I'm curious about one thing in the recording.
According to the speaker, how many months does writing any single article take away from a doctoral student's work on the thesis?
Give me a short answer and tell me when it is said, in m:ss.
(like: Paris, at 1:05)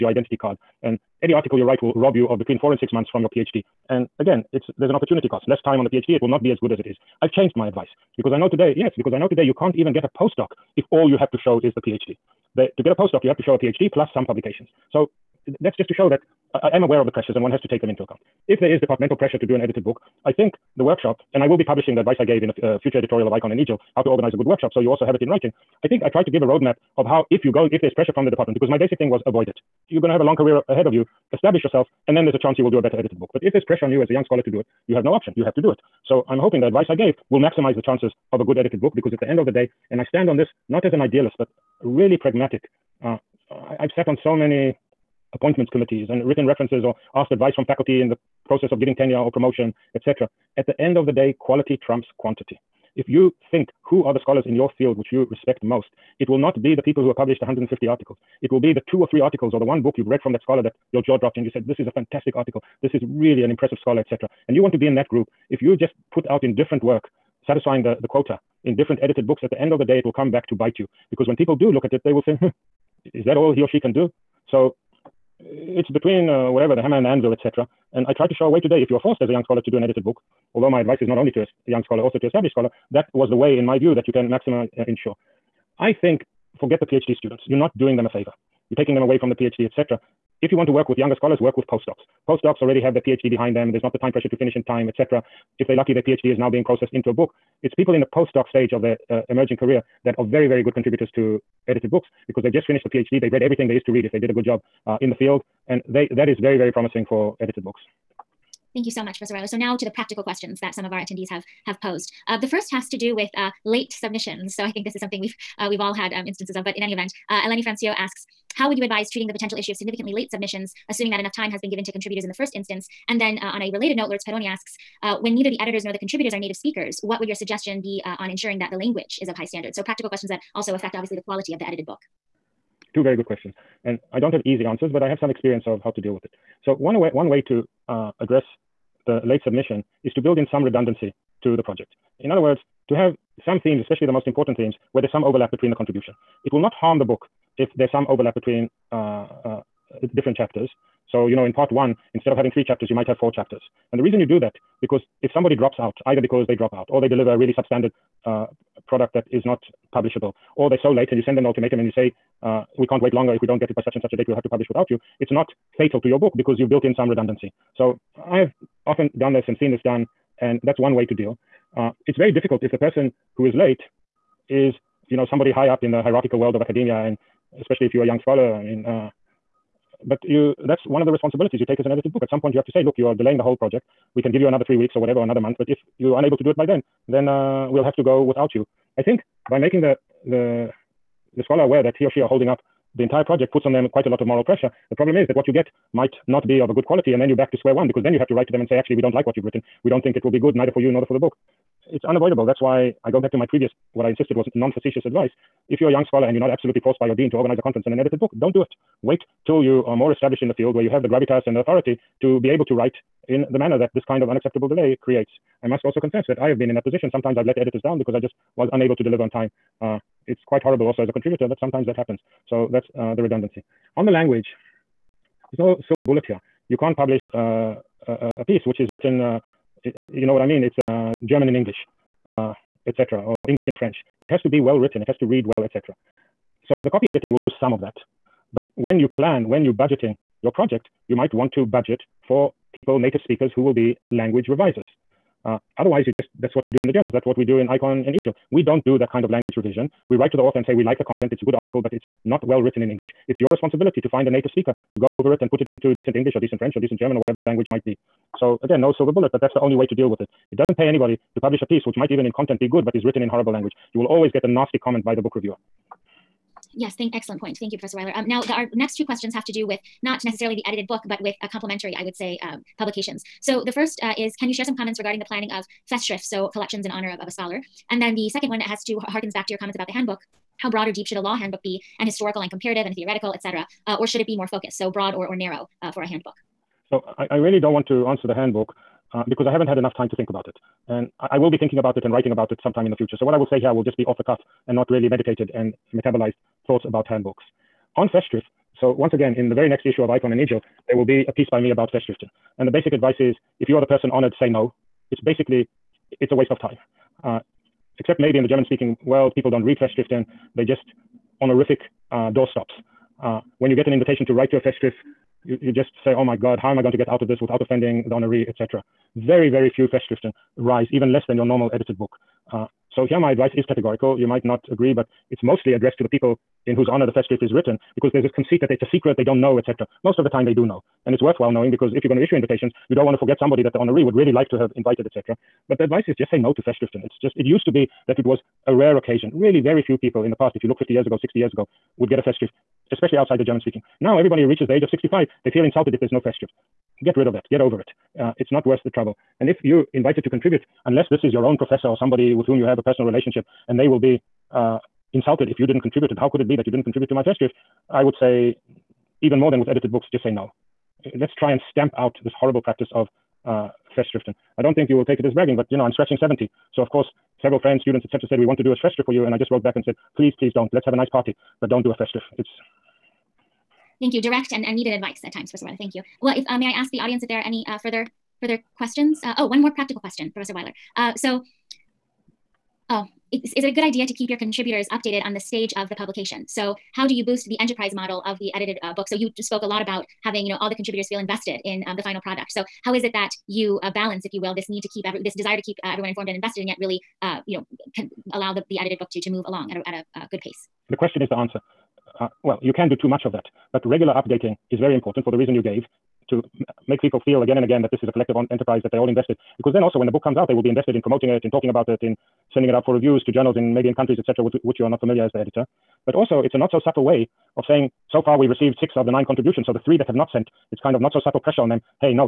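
4 to 6 months, at 0:02.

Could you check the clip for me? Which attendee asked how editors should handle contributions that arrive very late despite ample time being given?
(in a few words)
Eleni Frantziou.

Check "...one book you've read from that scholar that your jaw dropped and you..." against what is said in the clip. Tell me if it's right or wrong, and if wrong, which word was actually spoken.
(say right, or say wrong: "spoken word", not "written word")
right.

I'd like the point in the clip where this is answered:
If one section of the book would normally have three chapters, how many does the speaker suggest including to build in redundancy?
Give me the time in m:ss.
2:33.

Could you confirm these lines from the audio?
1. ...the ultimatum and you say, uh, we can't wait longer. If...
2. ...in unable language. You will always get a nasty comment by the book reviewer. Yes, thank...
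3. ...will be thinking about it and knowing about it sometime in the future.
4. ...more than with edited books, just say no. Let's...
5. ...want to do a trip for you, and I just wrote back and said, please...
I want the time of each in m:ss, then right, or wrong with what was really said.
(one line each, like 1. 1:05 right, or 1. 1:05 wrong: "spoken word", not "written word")
1. 2:41 right
2. 4:23 wrong: "horrible", not "unable"
3. 4:51 wrong: "writing", not "knowing"
4. 5:59 right
5. 6:08 right.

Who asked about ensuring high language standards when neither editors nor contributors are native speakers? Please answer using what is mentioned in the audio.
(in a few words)
Lourdes Peroni.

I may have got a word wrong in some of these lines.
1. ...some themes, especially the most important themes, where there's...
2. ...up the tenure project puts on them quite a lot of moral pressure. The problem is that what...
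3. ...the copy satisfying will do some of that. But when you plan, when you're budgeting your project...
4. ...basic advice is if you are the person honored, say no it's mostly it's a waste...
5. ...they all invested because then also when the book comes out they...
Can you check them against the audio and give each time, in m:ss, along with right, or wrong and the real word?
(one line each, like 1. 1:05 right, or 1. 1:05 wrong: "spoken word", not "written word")
1. 2:23 right
2. 3:12 wrong: "entire", not "tenure"
3. 3:56 wrong: "editing", not "satisfying"
4. 5:02 wrong: "basically", not "mostly"
5. 6:48 right.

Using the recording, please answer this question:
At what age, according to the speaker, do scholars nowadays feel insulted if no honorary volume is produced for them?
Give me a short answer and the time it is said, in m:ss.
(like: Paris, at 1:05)
65, at 5:44.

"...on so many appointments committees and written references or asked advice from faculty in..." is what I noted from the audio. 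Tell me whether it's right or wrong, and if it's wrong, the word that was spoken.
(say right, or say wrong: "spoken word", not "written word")
right.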